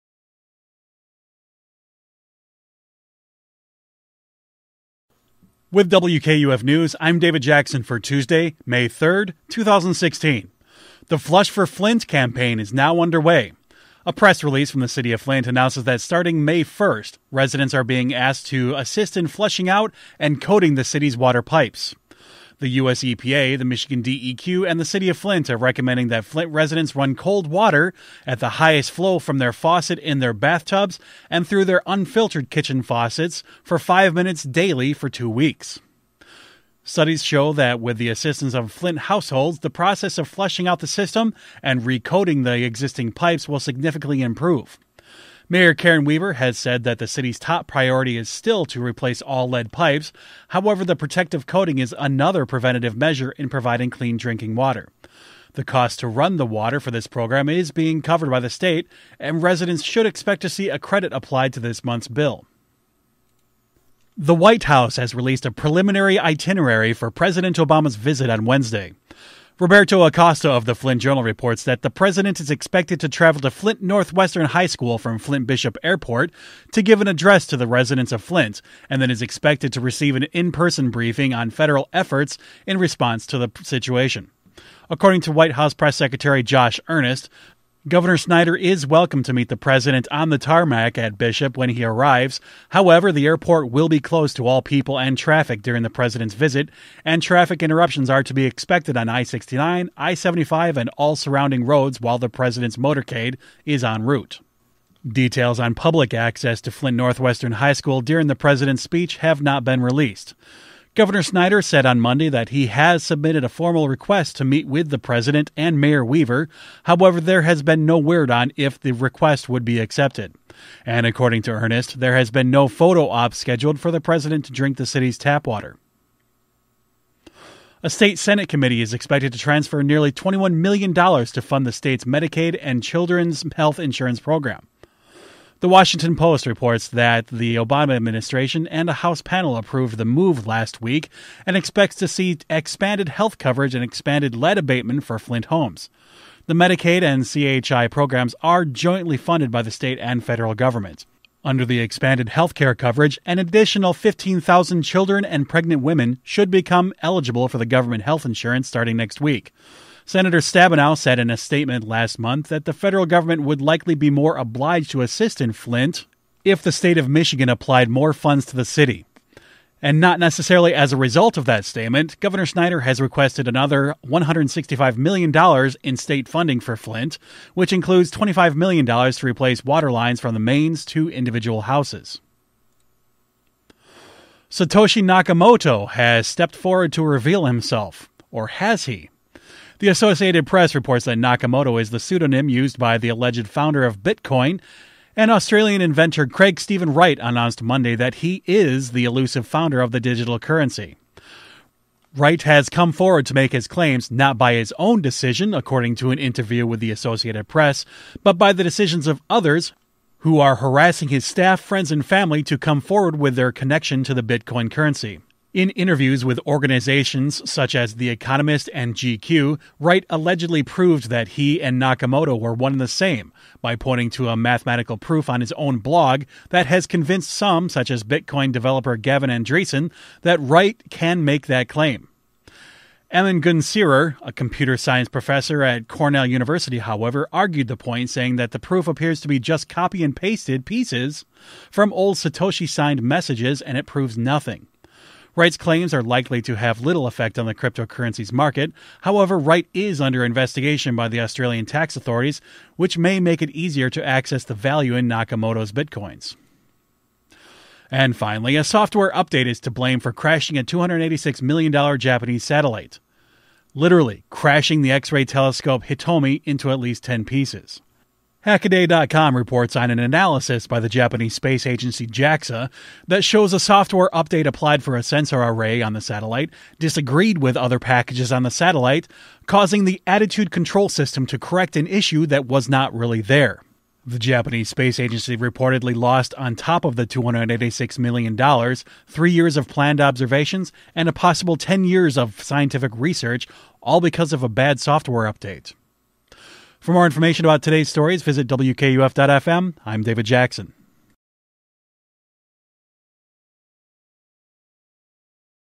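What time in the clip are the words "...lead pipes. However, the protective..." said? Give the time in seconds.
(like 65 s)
49 s.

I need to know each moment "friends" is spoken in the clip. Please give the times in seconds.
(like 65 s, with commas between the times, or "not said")
211 s.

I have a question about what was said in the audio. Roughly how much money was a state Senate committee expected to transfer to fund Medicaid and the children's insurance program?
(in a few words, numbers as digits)
$21 million.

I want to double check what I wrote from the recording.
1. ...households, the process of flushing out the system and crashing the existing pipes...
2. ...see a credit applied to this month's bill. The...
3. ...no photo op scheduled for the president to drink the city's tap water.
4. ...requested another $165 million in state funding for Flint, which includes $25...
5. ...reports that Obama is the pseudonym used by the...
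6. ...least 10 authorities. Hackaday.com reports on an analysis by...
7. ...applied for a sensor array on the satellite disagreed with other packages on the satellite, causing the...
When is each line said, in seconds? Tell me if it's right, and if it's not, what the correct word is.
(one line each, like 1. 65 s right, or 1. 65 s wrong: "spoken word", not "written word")
1. 38 s wrong: "recoding", not "crashing"
2. 60 s right
3. 122 s right
4. 173 s right
5. 190 s wrong: "Nakamoto", not "Obama"
6. 266 s wrong: "pieces", not "authorities"
7. 274 s right.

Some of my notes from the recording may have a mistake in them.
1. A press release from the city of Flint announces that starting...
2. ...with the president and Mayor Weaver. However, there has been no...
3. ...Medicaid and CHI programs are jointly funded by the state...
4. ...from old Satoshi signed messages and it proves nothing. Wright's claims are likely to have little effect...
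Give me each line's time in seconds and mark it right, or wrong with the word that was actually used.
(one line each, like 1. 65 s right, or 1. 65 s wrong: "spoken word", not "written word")
1. 14 s right
2. 114 s right
3. 146 s right
4. 241 s right.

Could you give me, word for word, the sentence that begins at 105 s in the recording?
Details on public access to Flint Northwestern High School during the president's speech have not been released.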